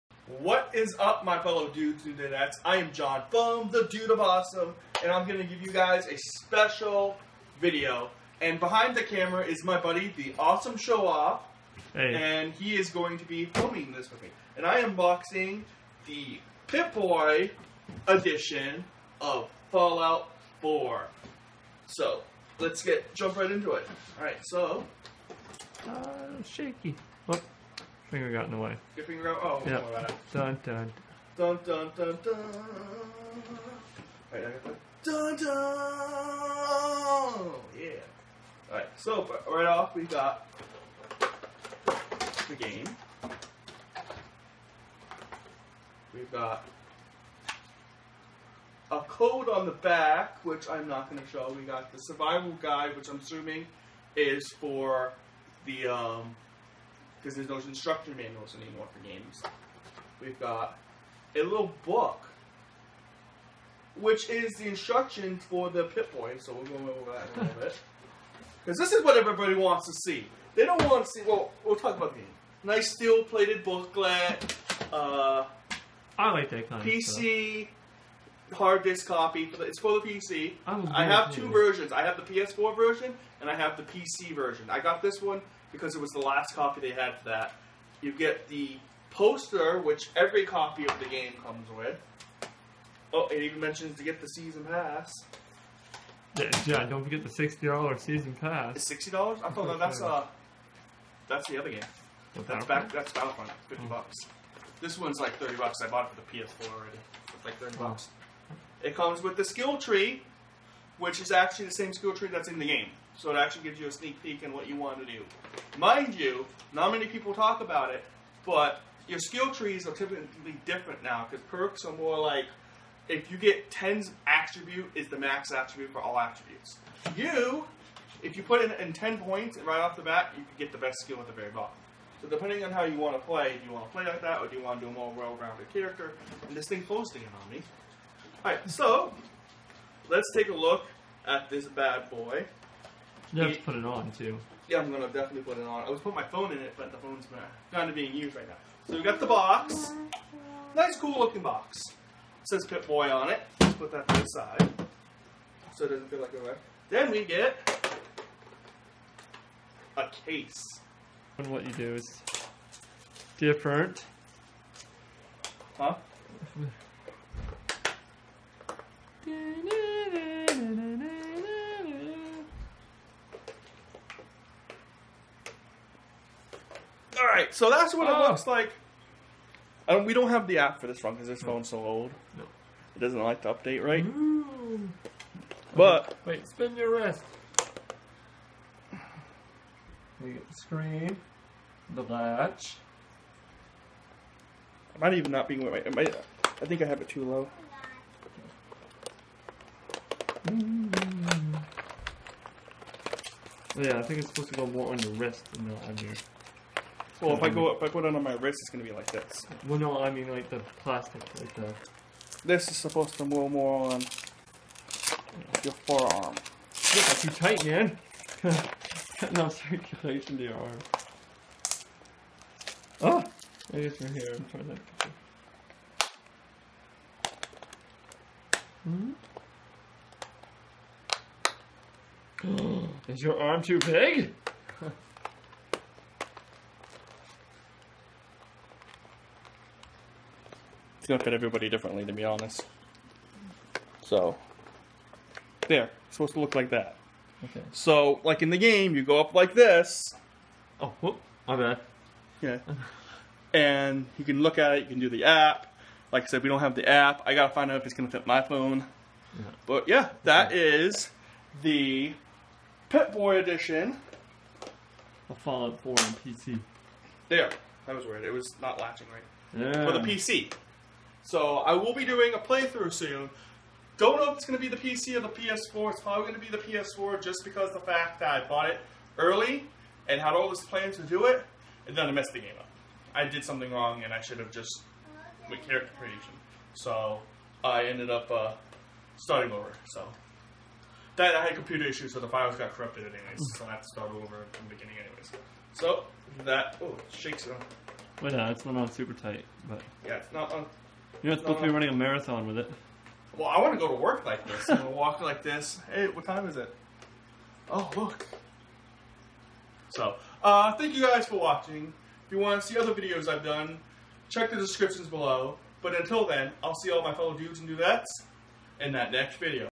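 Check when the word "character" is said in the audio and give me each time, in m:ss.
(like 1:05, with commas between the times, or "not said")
2:15, 4:45.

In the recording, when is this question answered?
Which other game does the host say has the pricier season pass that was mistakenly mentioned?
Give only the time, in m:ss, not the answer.
1:43.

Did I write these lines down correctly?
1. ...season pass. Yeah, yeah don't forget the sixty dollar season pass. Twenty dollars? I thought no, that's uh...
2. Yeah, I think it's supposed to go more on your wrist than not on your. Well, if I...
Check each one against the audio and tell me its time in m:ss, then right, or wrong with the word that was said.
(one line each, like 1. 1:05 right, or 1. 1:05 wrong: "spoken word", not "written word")
1. 1:34 wrong: "Sixty", not "Twenty"
2. 3:23 right.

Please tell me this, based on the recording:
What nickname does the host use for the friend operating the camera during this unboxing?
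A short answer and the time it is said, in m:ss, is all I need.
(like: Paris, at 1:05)
Awesome Show Off, at 0:10.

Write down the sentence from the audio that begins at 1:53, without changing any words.
So it actually gives you a sneak peek in what you want to do.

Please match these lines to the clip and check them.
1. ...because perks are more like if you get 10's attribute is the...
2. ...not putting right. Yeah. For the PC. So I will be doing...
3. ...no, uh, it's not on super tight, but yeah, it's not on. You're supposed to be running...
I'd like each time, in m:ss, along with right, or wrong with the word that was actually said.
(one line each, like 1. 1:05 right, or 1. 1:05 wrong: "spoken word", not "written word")
1. 2:01 right
2. 4:28 wrong: "latching", not "putting"
3. 4:58 right.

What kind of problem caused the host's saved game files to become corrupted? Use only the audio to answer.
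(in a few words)
Computer issues.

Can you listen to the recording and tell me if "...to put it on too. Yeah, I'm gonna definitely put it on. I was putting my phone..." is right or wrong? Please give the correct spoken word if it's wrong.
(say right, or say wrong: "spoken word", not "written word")
right.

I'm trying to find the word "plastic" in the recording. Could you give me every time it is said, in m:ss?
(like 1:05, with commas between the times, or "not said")
3:30.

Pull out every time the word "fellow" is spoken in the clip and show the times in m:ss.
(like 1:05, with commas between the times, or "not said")
0:01, 5:17.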